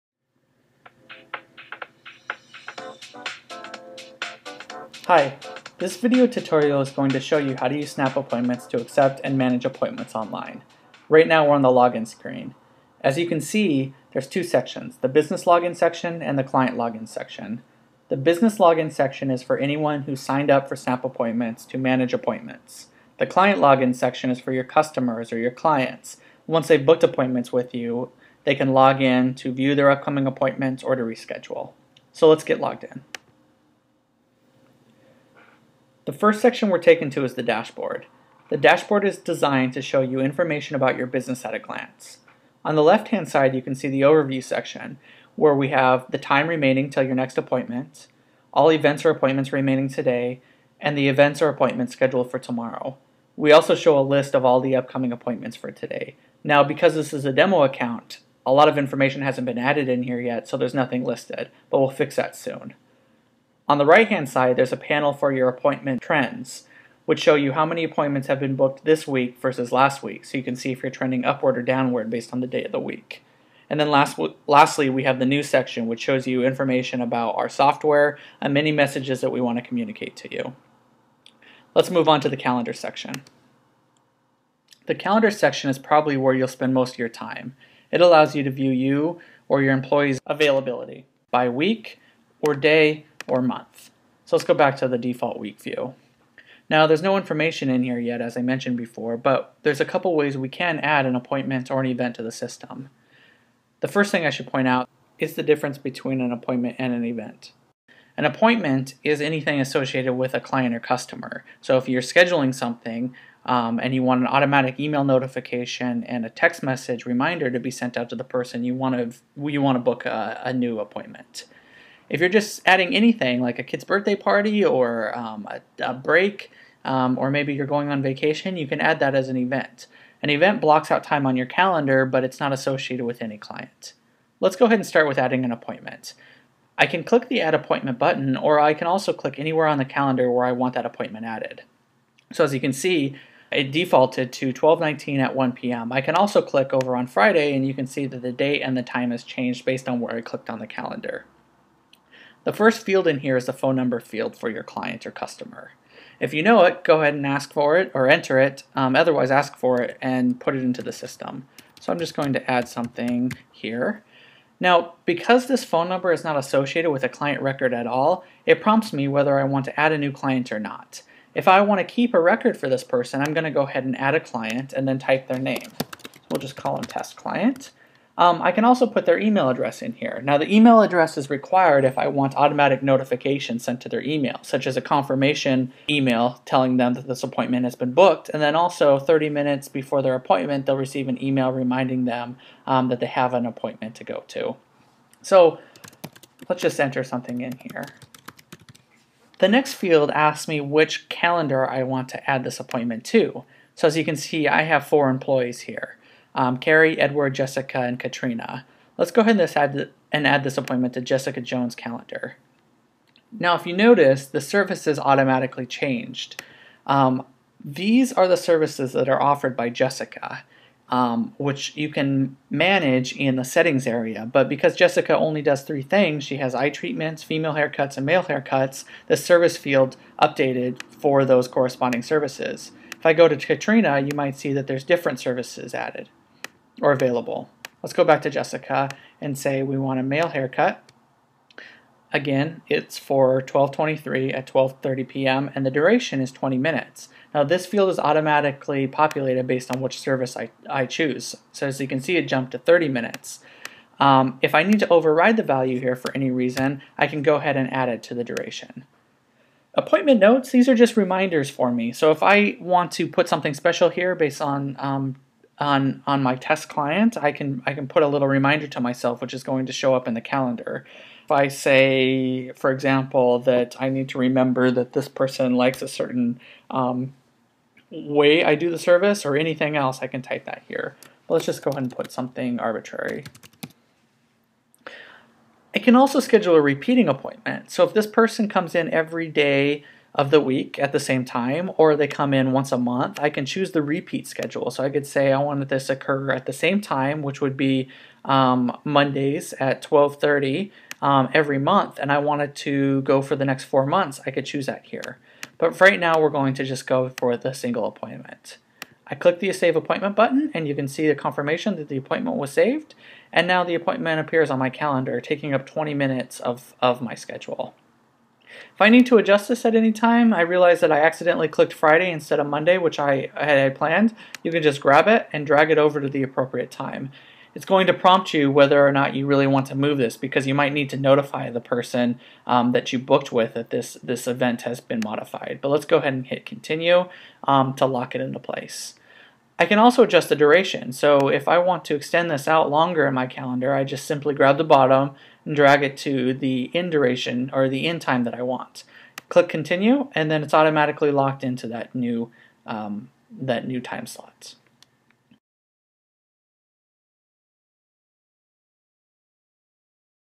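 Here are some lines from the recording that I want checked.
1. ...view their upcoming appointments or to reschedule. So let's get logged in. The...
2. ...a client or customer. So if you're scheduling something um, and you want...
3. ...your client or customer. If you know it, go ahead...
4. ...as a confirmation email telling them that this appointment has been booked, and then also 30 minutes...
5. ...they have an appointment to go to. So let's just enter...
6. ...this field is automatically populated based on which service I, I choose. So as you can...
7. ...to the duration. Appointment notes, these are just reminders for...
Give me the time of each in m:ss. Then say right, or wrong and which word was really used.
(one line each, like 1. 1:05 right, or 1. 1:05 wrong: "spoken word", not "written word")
1. 0:29 right
2. 1:50 right
3. 2:34 right
4. 3:04 right
5. 3:12 right
6. 4:07 right
7. 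4:18 right.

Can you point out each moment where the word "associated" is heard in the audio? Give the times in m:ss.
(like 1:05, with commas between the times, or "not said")
1:49, 2:12, 2:46.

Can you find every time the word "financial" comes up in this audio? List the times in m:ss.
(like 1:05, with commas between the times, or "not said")
not said.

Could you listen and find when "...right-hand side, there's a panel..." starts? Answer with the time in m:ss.
1:03.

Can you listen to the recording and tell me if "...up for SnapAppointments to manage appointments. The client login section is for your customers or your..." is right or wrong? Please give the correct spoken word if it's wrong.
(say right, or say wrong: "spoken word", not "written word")
right.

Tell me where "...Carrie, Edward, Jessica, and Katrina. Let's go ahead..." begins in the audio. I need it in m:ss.
3:26.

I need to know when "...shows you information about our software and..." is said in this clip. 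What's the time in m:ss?
1:16.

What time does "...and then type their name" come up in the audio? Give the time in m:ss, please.
2:54.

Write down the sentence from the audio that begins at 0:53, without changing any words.
We also show a list of all the upcoming appointments for today.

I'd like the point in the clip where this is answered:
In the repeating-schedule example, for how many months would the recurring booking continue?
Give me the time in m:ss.
5:03.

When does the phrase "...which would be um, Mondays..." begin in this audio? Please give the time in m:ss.
4:57.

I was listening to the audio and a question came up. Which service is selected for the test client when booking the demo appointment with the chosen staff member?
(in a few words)
male haircut.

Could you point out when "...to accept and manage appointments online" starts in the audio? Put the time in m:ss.
0:08.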